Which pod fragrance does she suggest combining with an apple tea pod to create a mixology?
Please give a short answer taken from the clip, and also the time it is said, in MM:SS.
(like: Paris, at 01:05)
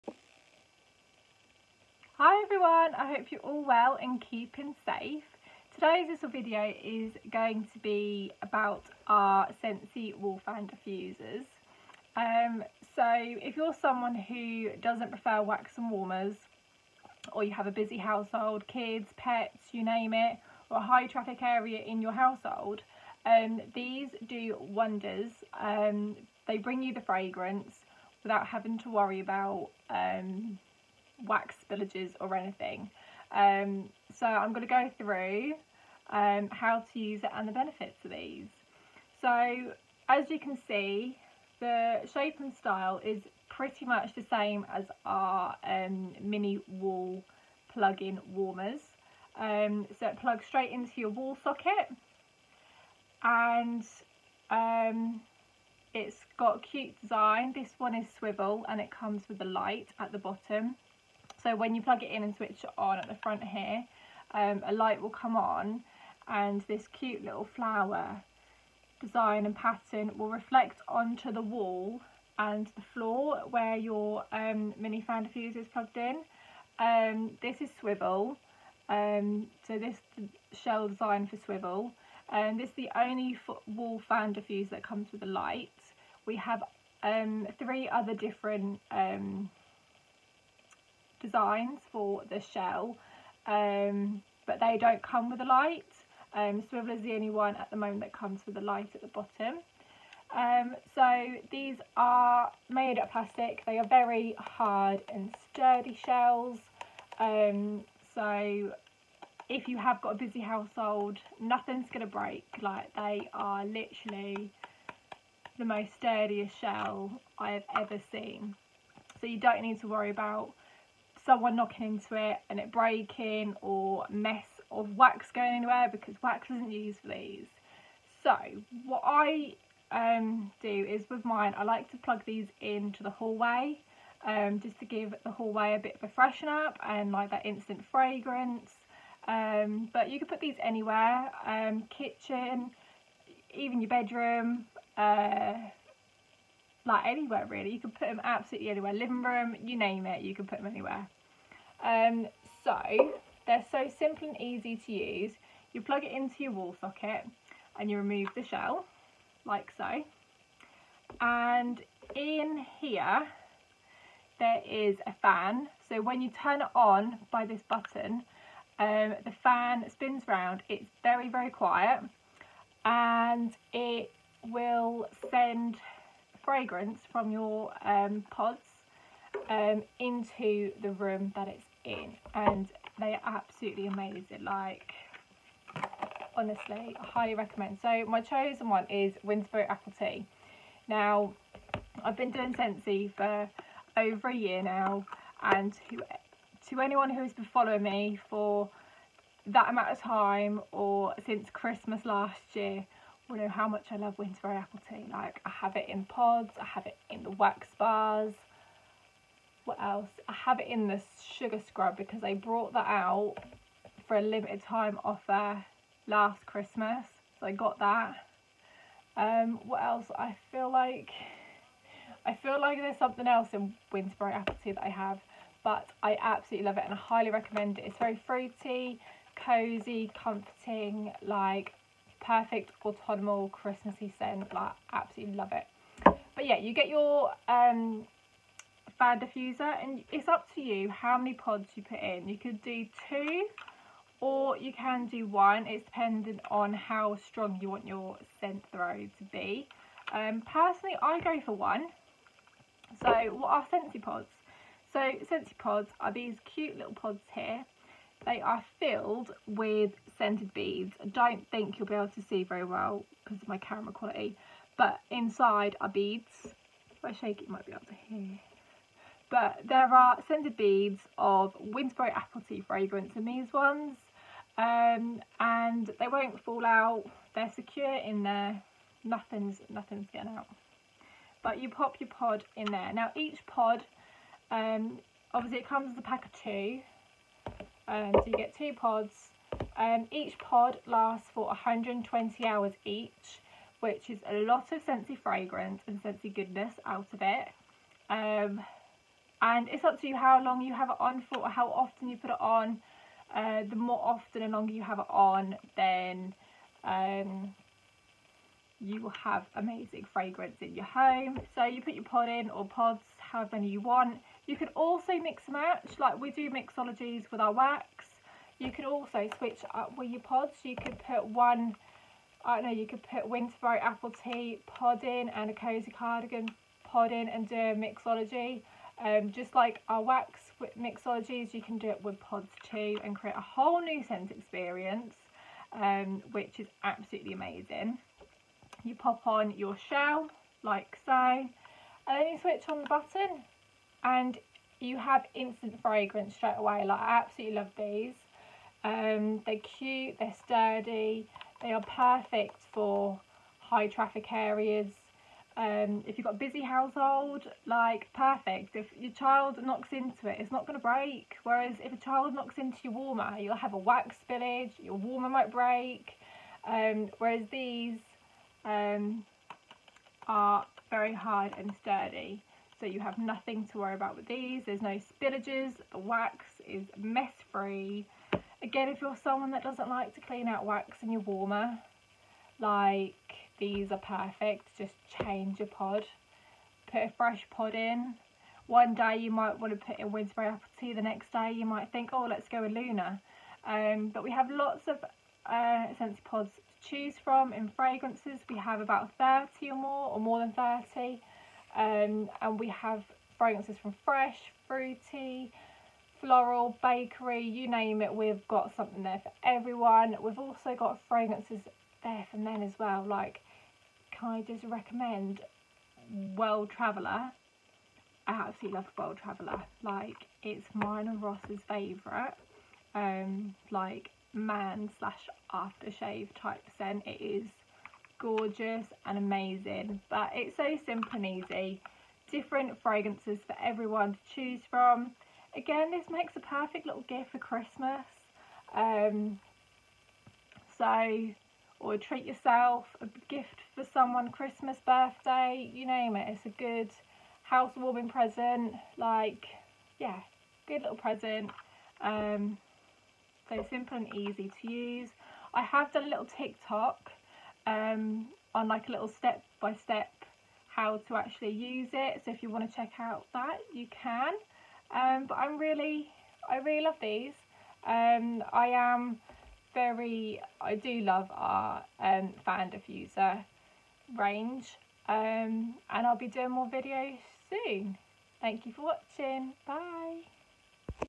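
Cozy Cardigan, at 05:25.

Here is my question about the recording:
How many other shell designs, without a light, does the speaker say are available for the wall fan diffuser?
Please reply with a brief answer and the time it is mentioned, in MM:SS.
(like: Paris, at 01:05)
3, at 01:27.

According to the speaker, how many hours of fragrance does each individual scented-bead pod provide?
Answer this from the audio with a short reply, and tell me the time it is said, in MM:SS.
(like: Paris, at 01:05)
120 hours, at 04:51.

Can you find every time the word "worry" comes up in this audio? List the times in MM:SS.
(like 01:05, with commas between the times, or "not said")
00:28, 01:59, 06:13.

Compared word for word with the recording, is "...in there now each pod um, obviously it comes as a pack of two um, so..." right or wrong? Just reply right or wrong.
right.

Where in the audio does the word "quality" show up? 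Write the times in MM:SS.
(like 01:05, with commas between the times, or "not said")
04:23.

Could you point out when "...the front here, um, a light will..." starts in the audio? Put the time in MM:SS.
01:03.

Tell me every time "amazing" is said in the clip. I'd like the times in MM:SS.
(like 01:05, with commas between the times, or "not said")
03:03, 05:09, 05:37, 07:09.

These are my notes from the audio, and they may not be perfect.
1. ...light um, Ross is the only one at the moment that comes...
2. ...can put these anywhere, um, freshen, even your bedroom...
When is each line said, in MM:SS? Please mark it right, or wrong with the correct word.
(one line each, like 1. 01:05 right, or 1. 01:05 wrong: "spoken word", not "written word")
1. 01:35 wrong: "Swivel", not "Ross"
2. 02:20 wrong: "kitchen", not "freshen".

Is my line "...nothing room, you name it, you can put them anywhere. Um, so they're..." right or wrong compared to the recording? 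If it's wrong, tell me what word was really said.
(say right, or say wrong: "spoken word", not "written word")
wrong: "living", not "nothing".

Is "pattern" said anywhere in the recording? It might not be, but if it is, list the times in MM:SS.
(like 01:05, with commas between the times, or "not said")
01:09.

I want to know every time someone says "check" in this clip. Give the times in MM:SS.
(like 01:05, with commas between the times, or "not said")
07:42.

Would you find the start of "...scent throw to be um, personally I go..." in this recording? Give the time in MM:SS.
04:08.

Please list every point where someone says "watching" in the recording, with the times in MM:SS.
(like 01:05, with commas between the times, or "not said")
07:58.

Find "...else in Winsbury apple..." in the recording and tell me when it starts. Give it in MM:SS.
03:43.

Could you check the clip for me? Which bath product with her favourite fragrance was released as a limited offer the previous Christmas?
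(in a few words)
Sugar scrub.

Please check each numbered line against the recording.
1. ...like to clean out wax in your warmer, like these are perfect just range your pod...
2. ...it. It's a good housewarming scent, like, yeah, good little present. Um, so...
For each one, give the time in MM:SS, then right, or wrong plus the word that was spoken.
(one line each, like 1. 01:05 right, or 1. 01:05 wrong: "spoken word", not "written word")
1. 06:19 wrong: "change", not "range"
2. 07:26 wrong: "present", not "scent".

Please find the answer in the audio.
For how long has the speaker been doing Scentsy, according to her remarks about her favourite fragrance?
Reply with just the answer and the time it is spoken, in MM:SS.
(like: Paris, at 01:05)
Over a year, at 03:13.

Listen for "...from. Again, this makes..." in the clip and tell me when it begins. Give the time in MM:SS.
07:14.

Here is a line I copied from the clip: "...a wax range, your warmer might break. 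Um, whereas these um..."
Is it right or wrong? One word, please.
wrong.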